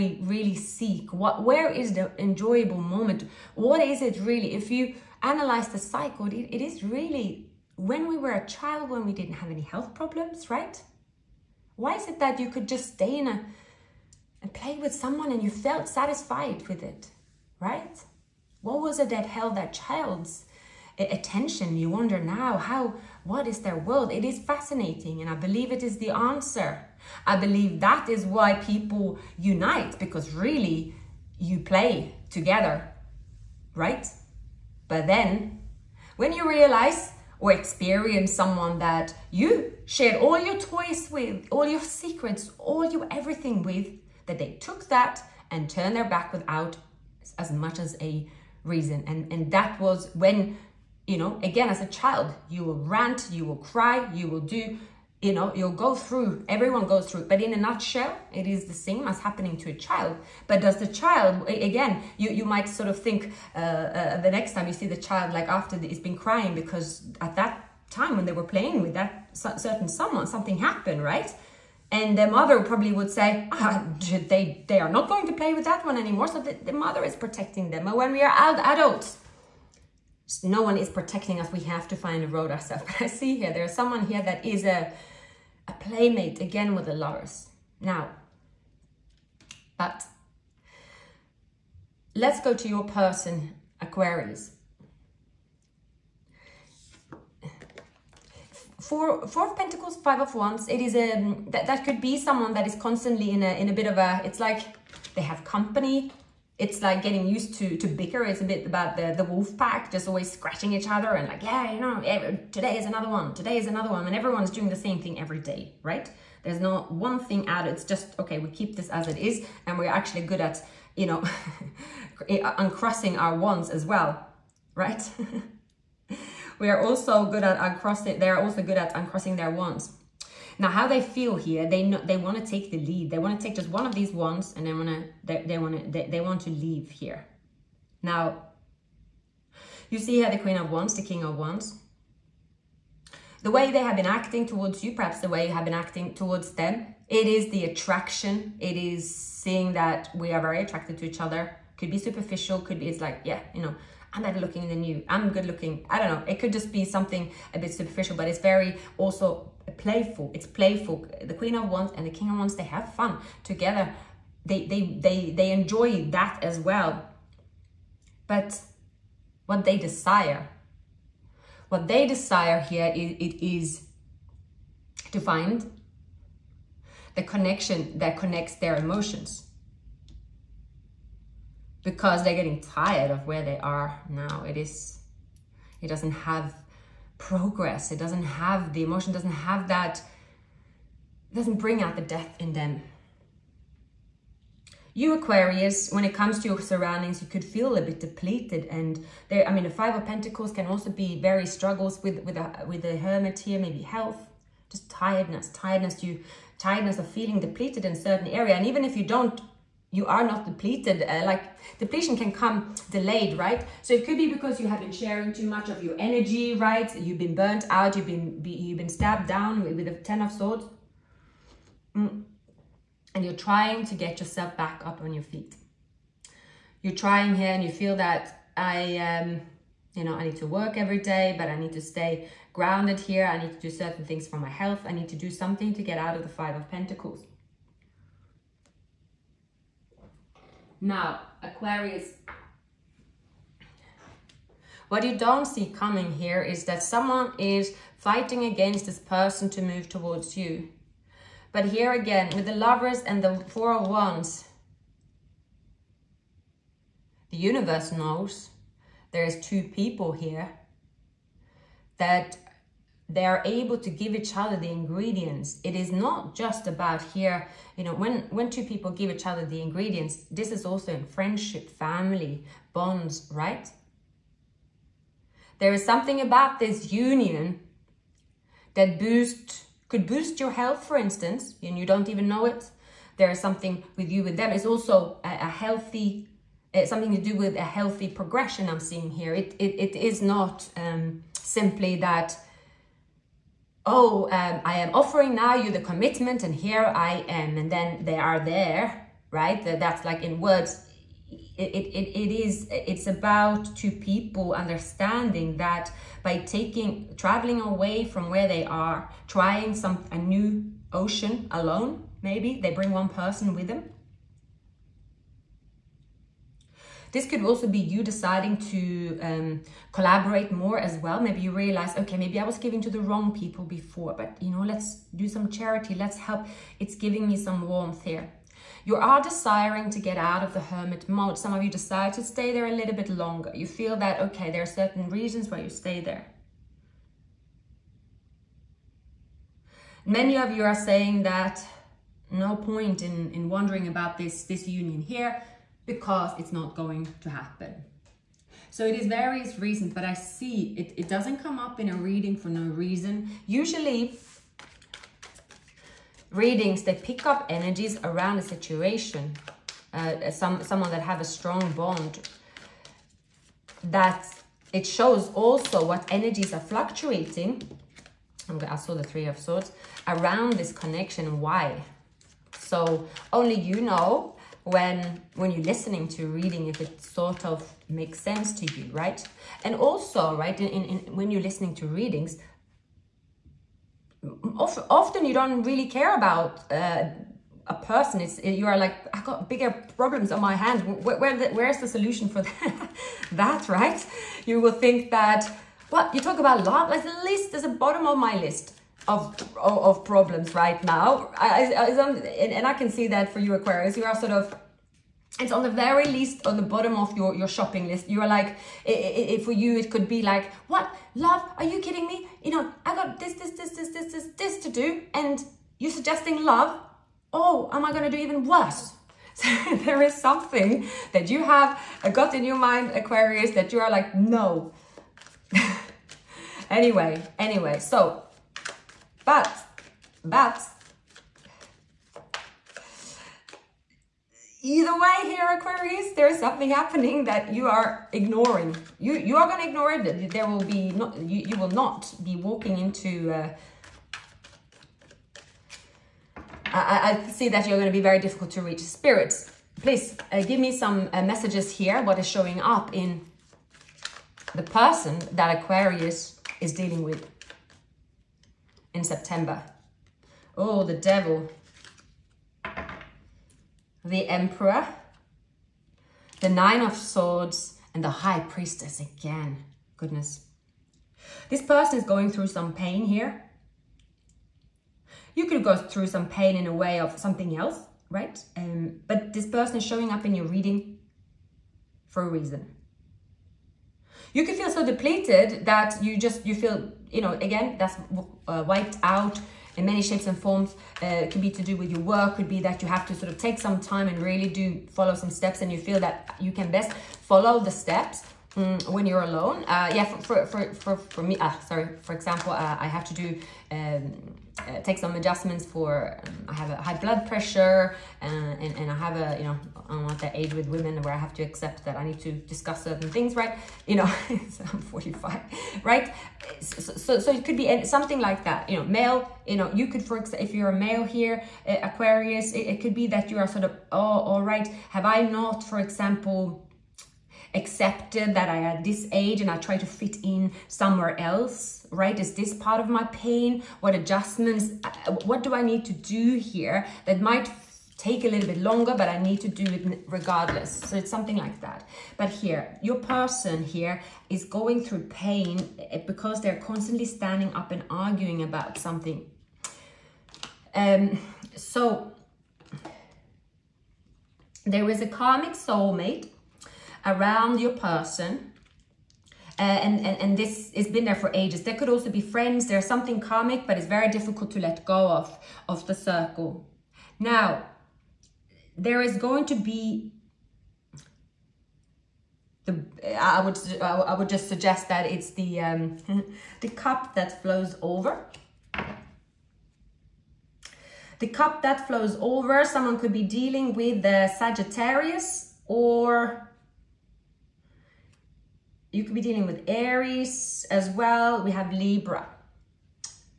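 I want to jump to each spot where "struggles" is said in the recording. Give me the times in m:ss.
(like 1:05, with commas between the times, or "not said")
3:21.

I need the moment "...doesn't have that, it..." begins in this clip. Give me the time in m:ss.
3:09.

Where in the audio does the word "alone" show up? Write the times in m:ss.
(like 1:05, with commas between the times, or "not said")
5:11, 8:19.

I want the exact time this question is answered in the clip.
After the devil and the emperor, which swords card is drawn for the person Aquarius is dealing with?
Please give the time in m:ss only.
7:46.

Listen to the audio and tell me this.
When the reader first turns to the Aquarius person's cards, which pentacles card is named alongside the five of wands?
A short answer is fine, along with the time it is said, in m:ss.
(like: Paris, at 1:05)
Four of Pentacles, at 1:38.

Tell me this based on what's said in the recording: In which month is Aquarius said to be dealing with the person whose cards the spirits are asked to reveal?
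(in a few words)
September.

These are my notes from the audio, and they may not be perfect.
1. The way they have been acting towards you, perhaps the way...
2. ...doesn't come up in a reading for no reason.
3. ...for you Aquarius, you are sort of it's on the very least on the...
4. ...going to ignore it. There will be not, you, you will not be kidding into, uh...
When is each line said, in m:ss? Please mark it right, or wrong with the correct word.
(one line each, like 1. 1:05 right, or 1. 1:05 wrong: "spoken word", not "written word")
1. 2:23 right
2. 5:51 right
3. 6:43 right
4. 7:19 wrong: "walking", not "kidding".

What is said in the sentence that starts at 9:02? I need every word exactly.
But here, your person here is going through pain eh, because they're constantly standing up and arguing about something.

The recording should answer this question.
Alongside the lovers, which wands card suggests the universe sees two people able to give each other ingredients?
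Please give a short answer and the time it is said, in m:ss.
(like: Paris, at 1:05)
Four of Wands, at 4:13.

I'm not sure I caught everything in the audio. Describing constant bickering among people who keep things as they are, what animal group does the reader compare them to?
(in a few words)
wolf pack.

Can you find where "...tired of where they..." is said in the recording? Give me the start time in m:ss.
3:02.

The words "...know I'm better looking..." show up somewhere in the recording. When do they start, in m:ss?
2:33.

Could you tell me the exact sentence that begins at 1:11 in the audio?
And the mother probably would say, ah, they, they are not going to play with that one anymore.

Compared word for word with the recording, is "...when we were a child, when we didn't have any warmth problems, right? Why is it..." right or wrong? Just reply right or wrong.
wrong.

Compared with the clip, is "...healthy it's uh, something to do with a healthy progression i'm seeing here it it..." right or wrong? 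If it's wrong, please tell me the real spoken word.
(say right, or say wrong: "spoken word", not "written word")
right.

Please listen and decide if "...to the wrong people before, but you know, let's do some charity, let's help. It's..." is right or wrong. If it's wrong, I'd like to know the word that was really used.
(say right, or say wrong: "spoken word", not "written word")
right.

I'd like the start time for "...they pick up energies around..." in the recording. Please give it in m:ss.
5:56.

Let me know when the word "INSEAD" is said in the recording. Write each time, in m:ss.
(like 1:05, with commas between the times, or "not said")
not said.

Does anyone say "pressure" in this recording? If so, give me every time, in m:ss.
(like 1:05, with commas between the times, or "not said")
8:27.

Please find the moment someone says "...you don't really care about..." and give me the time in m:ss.
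6:25.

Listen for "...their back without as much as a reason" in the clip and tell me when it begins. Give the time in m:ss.
0:45.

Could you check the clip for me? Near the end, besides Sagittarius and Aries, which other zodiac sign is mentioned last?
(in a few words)
Libra.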